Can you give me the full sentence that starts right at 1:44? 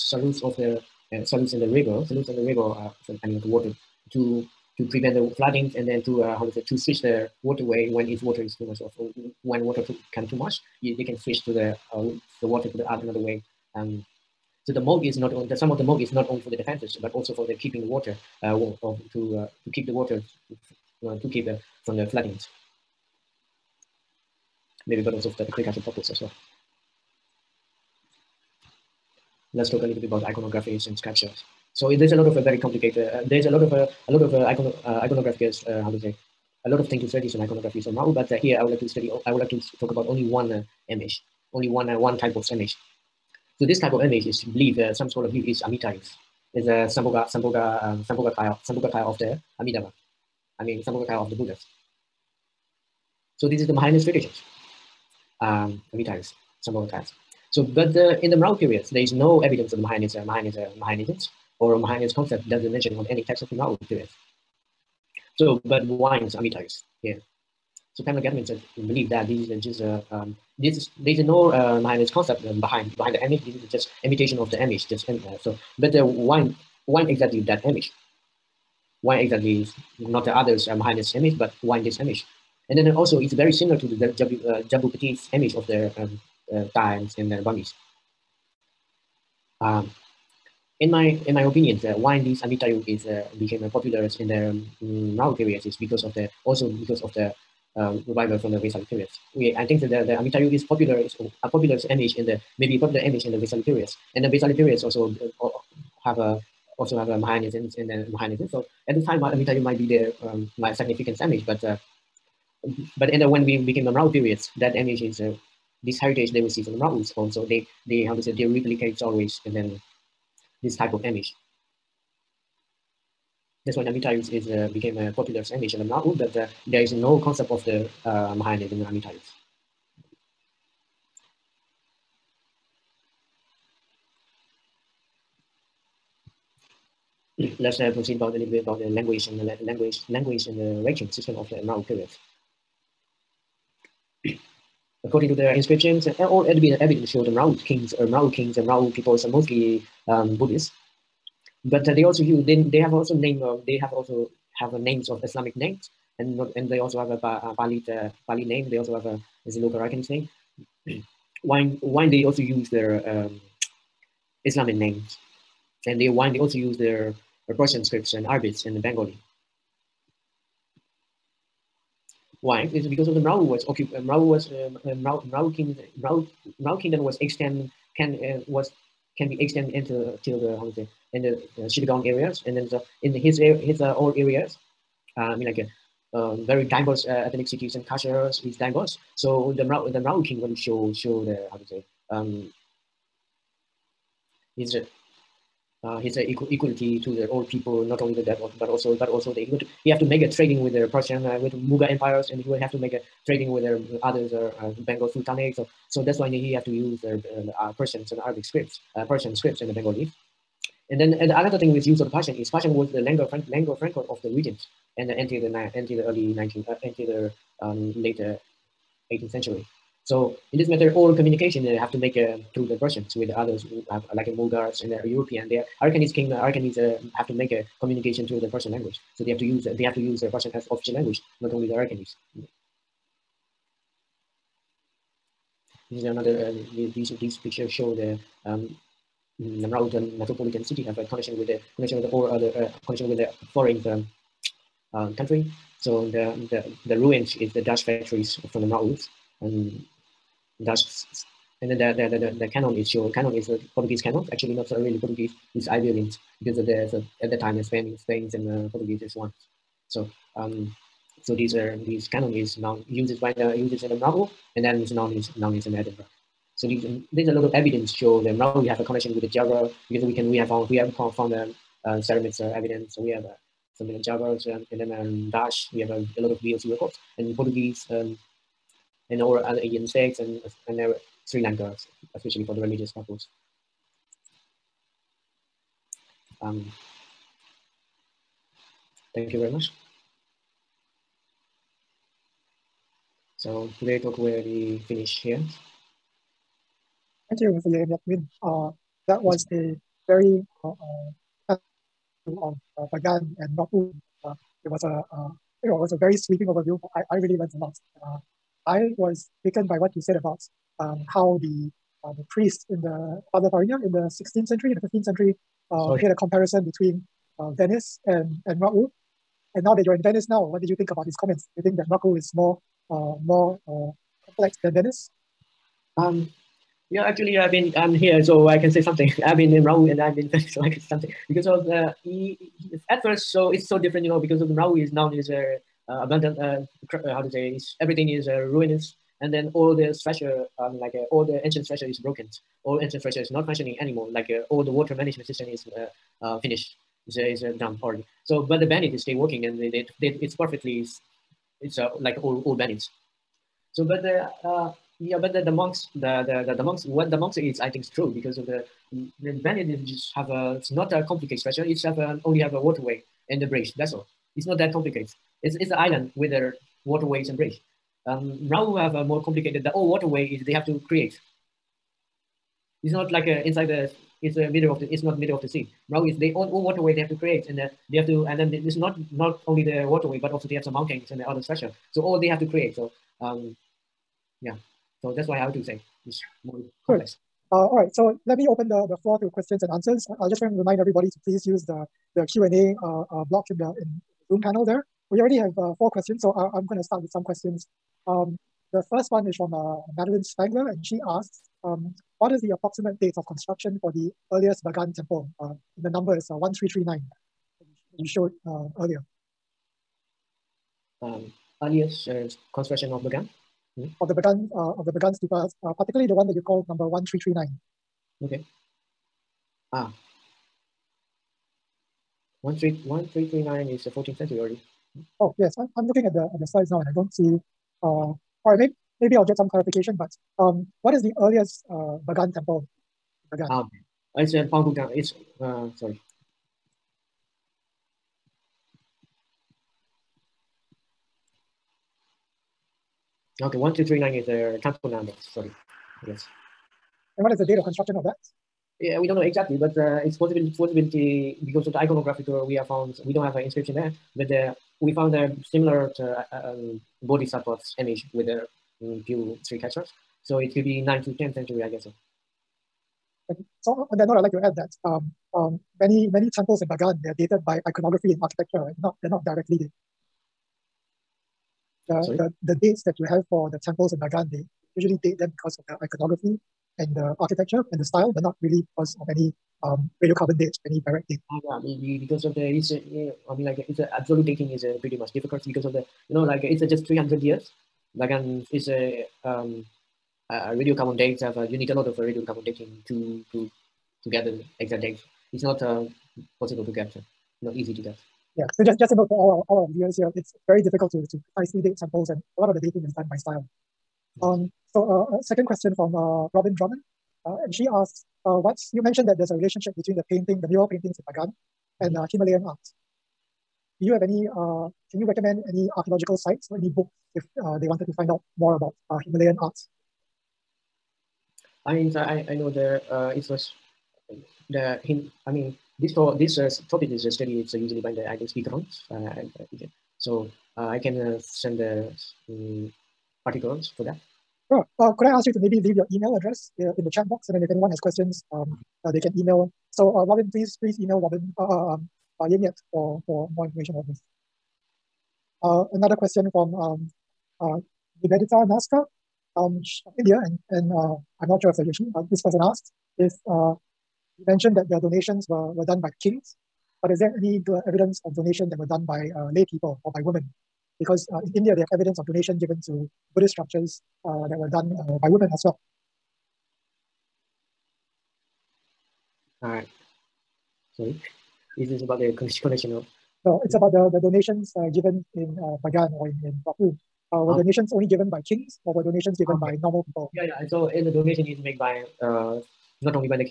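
And the Vaisali periods also uh, have a, also have a Mahayanism and then Mahayanism.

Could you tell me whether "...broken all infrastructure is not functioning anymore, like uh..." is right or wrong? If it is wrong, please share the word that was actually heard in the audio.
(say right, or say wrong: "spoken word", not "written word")
right.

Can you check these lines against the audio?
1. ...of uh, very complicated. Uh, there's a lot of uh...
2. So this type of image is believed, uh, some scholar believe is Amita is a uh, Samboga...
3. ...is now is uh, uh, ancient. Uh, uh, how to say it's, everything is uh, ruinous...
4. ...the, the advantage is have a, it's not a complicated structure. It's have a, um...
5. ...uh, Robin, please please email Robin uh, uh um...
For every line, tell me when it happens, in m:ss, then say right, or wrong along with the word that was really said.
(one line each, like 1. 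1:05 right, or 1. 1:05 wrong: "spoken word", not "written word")
1. 0:32 right
2. 0:43 right
3. 5:34 wrong: "abundant", not "ancient"
4. 5:58 right
5. 8:59 right.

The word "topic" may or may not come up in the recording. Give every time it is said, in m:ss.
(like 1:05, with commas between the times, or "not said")
8:46.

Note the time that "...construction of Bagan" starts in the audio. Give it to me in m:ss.
6:52.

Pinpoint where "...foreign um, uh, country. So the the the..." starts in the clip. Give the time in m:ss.
4:03.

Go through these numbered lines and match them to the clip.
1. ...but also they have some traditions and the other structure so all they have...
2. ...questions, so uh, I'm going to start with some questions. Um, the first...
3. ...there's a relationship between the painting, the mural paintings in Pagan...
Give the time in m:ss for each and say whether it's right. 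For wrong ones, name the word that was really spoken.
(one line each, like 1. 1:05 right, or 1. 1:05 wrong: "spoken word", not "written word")
1. 6:20 wrong: "mountains", not "traditions"
2. 6:35 right
3. 8:29 right.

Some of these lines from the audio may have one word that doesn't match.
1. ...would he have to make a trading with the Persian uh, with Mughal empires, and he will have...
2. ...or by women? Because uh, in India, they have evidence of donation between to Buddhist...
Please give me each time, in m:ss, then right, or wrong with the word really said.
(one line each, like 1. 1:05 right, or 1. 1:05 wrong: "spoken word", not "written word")
1. 3:19 right
2. 9:19 wrong: "given", not "between".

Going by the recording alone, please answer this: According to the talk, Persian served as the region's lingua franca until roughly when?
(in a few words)
Later 18th century.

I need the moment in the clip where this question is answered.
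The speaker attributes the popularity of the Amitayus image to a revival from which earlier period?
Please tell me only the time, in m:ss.
1:38.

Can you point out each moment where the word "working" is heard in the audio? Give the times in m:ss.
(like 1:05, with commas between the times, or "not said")
5:49.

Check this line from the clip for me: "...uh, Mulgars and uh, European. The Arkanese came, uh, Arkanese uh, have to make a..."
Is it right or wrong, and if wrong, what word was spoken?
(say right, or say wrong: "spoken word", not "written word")
right.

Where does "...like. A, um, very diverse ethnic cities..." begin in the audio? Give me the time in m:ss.
3:05.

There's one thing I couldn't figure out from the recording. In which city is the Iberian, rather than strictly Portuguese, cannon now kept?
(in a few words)
Edinburgh.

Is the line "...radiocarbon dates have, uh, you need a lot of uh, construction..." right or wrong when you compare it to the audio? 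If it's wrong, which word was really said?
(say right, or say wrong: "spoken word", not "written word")
wrong: "radiocarbon", not "construction".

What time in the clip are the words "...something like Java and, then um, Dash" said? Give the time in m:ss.
4:33.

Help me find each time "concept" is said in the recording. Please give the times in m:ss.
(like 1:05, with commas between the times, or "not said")
1:02, 1:12, 2:07.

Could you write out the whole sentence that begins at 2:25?
According to the inscriptions, all evidence showed the Mrao kings, uh, or Mrao kings, and Mrao peoples are mostly um, Buddhists.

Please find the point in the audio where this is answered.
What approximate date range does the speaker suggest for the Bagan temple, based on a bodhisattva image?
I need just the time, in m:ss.
7:40.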